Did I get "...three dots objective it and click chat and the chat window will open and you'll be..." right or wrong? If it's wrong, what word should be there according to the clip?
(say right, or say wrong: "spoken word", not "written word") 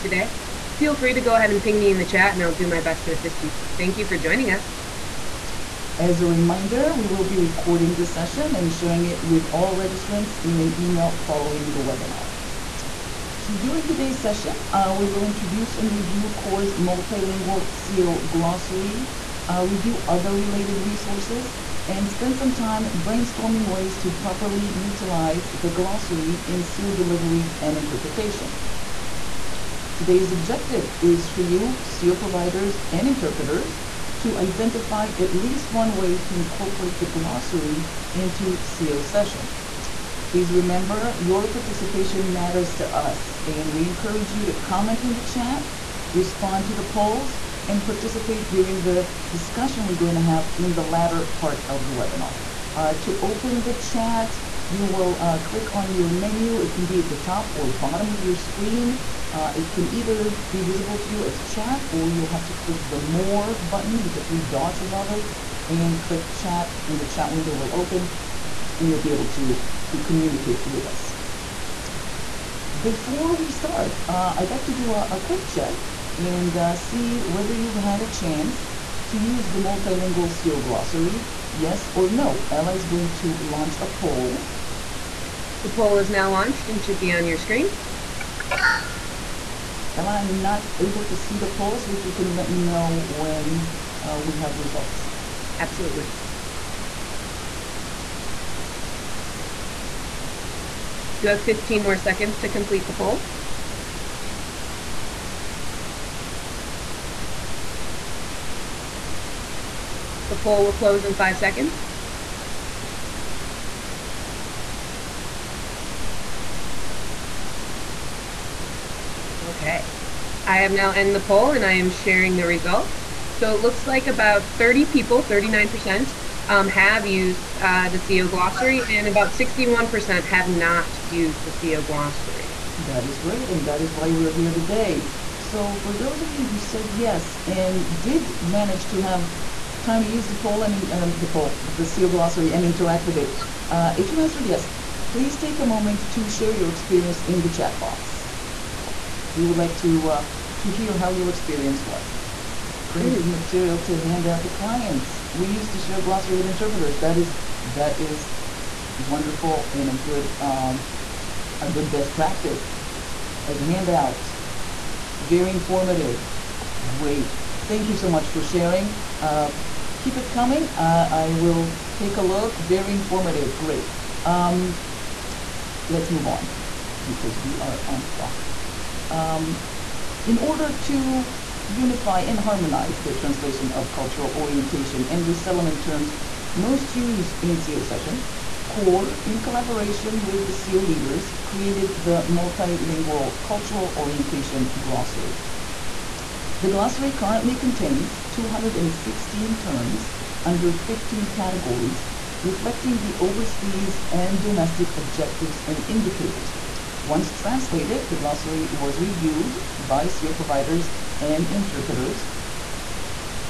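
wrong: "above", not "objective".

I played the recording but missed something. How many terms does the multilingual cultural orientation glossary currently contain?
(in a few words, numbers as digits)
216.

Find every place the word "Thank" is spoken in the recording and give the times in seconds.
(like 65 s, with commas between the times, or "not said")
3 s, 167 s.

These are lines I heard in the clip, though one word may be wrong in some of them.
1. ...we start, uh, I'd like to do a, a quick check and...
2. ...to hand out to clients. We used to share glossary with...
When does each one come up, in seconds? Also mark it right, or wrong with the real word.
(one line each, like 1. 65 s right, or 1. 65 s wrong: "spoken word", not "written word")
1. 73 s right
2. 153 s right.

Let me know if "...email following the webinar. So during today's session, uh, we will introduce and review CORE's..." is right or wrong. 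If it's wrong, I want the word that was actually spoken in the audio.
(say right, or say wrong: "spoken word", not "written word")
right.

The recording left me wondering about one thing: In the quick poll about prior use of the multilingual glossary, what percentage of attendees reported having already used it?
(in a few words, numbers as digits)
39%.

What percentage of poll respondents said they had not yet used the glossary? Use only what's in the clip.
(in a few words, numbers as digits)
61%.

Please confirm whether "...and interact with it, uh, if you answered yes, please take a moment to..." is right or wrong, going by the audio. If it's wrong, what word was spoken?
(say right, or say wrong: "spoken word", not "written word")
right.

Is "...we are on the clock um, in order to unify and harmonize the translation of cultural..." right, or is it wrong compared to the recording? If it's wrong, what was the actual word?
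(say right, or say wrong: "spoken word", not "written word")
right.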